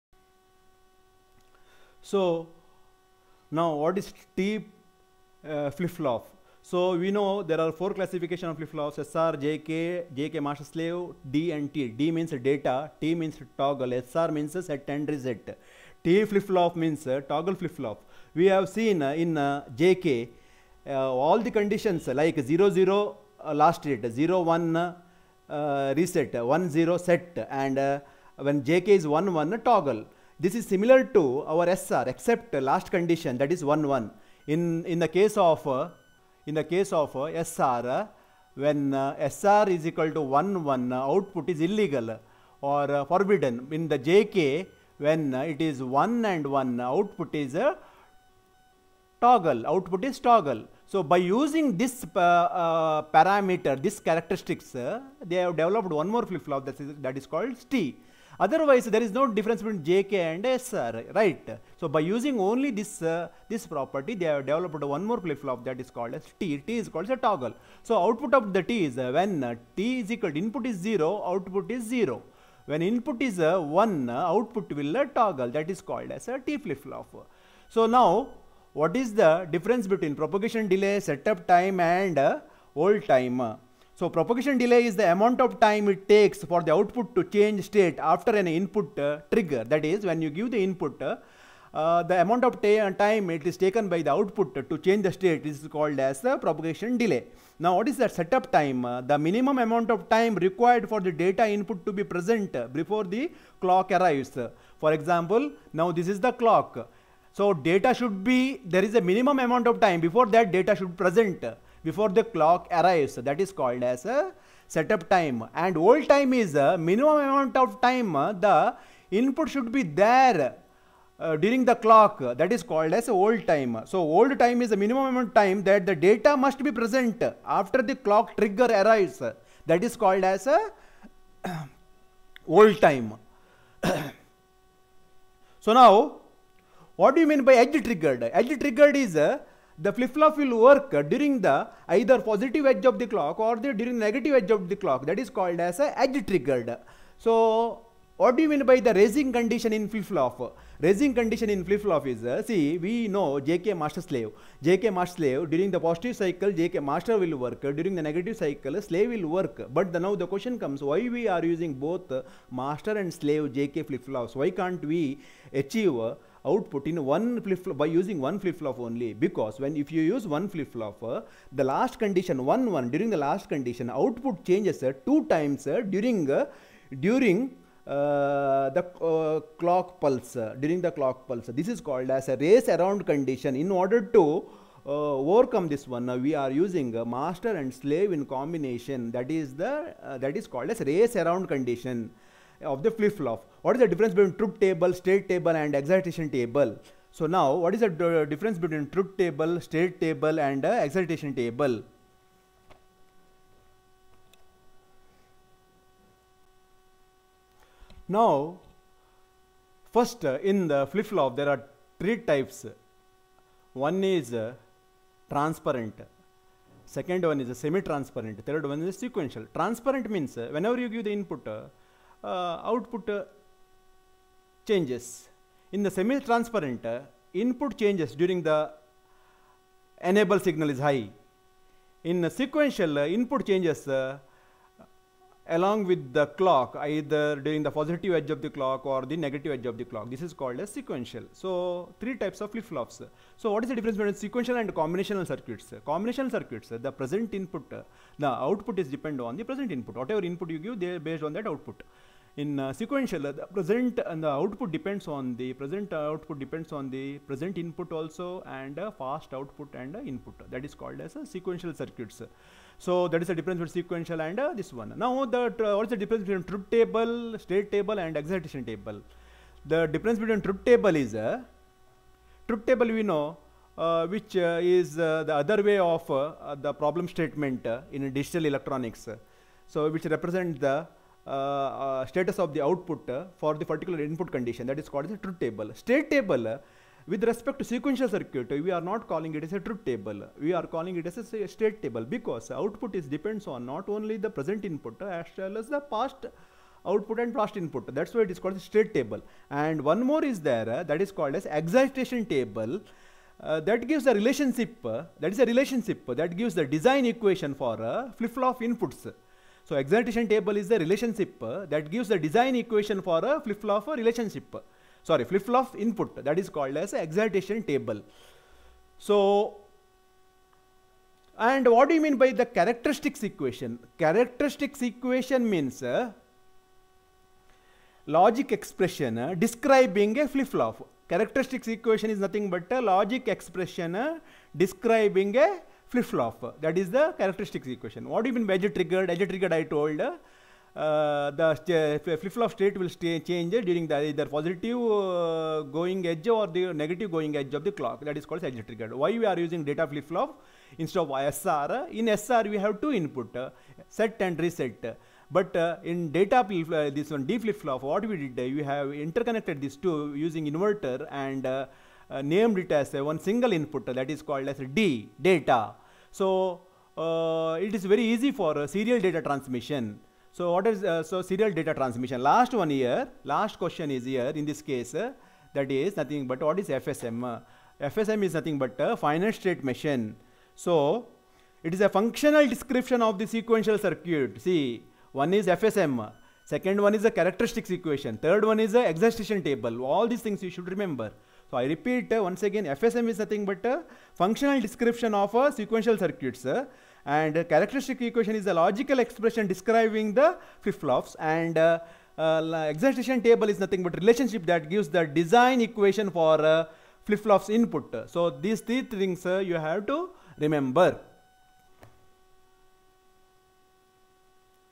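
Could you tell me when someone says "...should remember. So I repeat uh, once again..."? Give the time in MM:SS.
06:30.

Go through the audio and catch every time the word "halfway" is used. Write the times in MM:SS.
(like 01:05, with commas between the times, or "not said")
not said.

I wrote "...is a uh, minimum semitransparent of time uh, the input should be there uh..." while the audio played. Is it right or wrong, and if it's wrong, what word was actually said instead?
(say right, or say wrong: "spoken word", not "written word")
wrong: "amount", not "semitransparent".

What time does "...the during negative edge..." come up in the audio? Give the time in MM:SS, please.
02:23.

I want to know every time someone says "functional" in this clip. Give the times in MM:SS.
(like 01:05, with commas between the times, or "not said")
06:21, 06:34.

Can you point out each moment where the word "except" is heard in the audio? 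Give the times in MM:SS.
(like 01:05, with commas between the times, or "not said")
00:32.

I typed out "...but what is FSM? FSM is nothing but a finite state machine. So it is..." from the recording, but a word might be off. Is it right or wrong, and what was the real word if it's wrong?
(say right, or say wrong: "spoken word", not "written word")
right.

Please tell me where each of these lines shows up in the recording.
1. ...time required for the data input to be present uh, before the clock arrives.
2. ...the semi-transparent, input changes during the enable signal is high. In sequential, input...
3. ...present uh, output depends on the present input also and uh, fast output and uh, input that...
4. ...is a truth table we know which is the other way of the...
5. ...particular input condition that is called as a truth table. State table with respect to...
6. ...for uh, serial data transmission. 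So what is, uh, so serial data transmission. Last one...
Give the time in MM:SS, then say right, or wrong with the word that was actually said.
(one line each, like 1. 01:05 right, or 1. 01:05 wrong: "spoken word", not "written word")
1. 01:40 right
2. 03:45 right
3. 04:15 right
4. 04:30 right
5. 04:43 right
6. 06:08 right.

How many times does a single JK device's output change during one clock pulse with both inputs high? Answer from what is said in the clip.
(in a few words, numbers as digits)
two times.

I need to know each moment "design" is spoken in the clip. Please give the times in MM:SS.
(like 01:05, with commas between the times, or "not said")
05:06, 05:12, 06:45.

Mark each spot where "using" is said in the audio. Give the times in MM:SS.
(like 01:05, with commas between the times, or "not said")
00:51, 01:01, 02:41, 02:47, 03:06, 05:49, 06:00.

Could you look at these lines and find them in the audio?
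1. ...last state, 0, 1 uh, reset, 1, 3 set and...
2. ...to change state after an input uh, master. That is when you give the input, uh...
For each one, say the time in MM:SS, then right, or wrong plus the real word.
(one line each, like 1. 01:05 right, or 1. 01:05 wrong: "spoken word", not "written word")
1. 00:23 wrong: "0", not "3"
2. 01:27 wrong: "trigger", not "master".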